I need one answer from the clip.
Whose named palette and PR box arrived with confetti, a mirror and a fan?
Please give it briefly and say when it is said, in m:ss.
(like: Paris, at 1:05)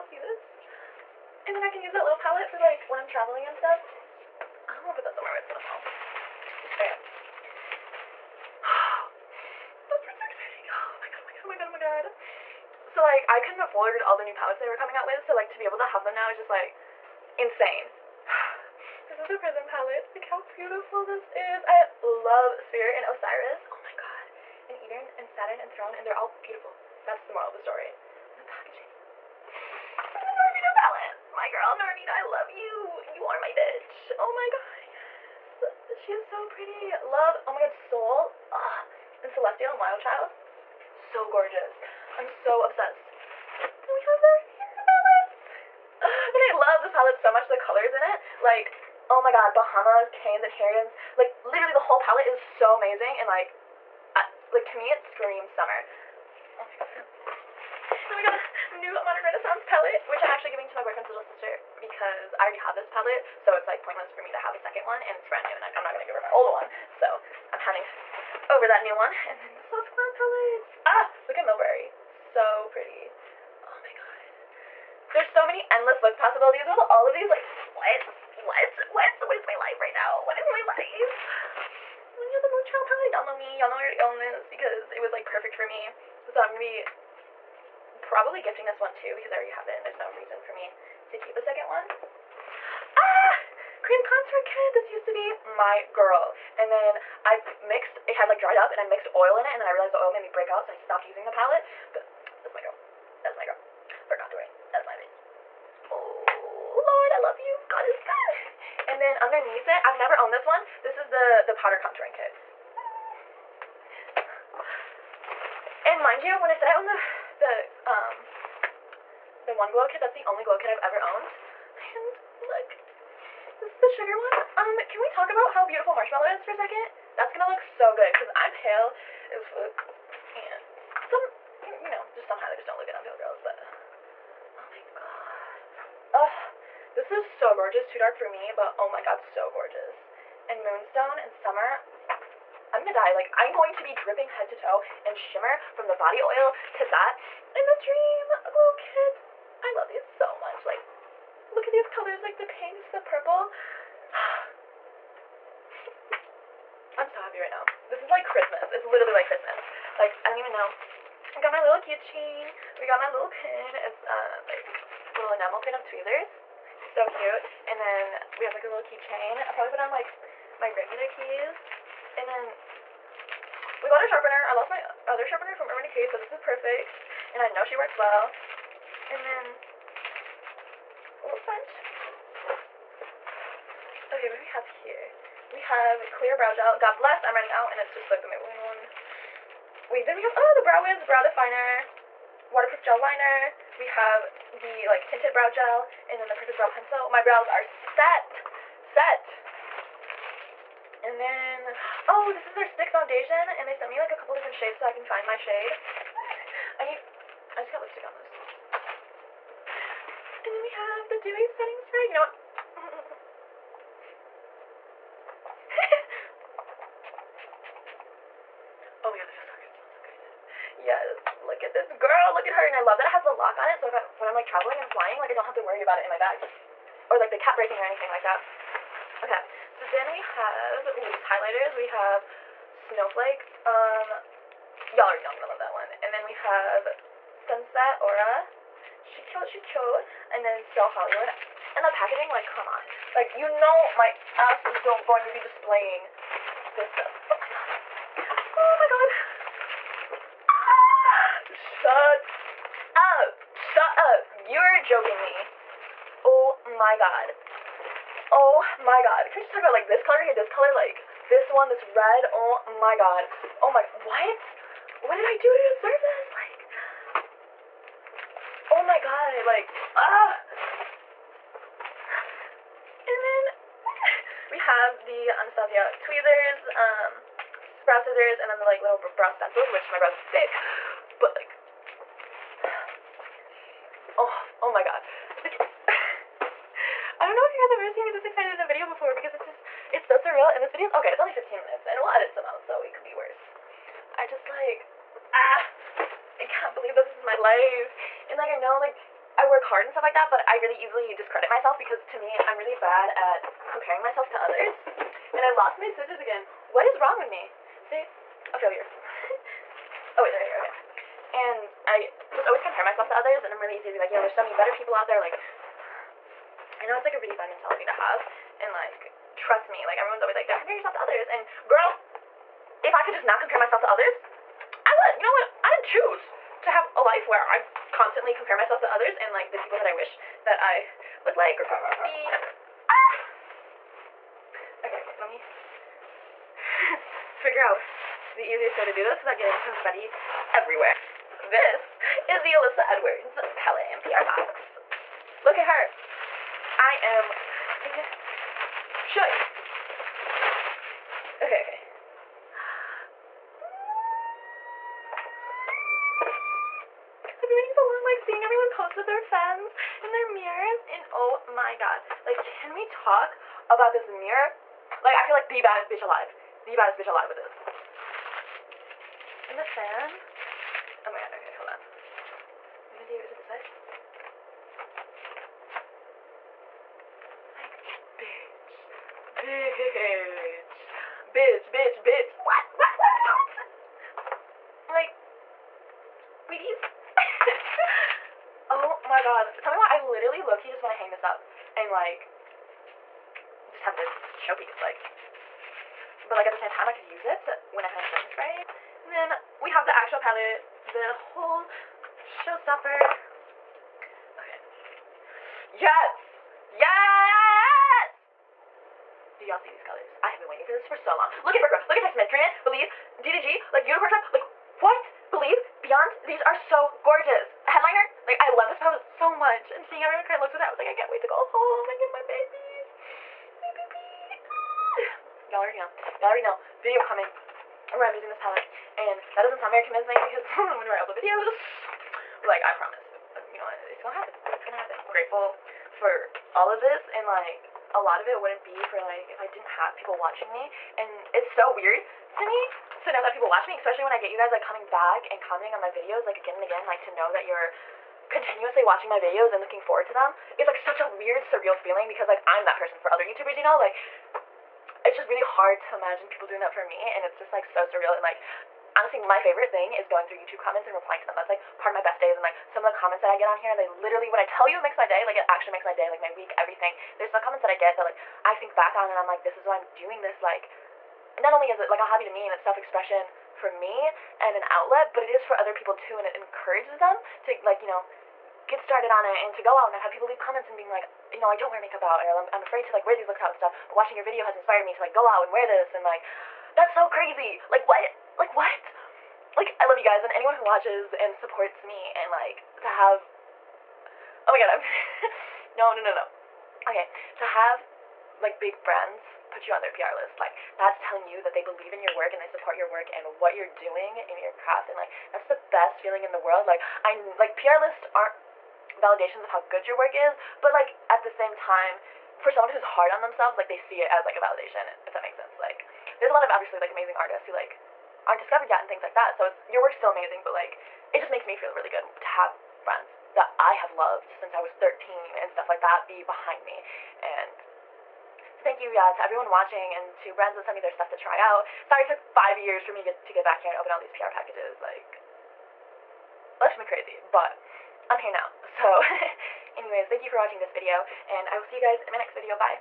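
Alyssa Edwards, at 5:42.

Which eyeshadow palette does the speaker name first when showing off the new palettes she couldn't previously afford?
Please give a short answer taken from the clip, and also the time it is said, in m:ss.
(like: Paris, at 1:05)
Prism, at 0:19.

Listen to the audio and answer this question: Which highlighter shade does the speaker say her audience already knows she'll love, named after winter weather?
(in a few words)
Snowflake.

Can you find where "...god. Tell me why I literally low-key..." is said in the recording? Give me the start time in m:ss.
6:29.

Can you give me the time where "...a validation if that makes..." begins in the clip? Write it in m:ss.
8:34.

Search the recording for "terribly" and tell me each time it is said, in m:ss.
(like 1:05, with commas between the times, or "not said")
not said.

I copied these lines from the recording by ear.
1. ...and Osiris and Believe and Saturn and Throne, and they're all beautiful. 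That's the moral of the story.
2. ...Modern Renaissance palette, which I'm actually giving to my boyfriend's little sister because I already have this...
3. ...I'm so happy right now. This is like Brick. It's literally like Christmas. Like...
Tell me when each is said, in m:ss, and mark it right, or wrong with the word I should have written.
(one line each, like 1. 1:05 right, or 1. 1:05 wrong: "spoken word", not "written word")
1. 0:22 wrong: "Eden", not "Believe"
2. 0:59 right
3. 2:36 wrong: "Christmas", not "Brick".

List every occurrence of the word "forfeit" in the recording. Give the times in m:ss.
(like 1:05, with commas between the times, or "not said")
not said.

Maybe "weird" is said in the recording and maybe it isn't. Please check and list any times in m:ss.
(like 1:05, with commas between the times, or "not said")
7:21, 7:31.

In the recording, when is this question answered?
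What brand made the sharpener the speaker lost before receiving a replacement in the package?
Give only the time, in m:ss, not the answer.
2:55.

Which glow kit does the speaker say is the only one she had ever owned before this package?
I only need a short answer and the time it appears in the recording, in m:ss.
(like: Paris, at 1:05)
Sugar, at 2:03.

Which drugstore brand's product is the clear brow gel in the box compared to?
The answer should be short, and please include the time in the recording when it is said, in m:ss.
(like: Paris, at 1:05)
Maybelline, at 3:08.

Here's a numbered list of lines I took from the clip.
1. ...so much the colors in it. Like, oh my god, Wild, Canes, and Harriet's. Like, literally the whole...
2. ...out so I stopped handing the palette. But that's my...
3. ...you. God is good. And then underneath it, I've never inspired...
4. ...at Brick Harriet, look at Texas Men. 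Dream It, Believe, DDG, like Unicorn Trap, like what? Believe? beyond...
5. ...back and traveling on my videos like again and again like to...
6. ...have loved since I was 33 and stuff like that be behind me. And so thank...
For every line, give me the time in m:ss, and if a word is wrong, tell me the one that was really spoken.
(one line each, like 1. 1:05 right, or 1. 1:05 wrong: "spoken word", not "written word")
1. 0:47 wrong: "Bahamas", not "Wild"
2. 1:40 wrong: "using", not "handing"
3. 1:47 wrong: "owned", not "inspired"
4. 6:51 wrong: "Road", not "Harriet"
5. 7:24 wrong: "commenting", not "traveling"
6. 8:43 wrong: "13", not "33".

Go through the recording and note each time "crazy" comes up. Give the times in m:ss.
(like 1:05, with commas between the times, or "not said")
8:07, 8:56.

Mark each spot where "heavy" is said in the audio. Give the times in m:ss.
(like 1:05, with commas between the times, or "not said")
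not said.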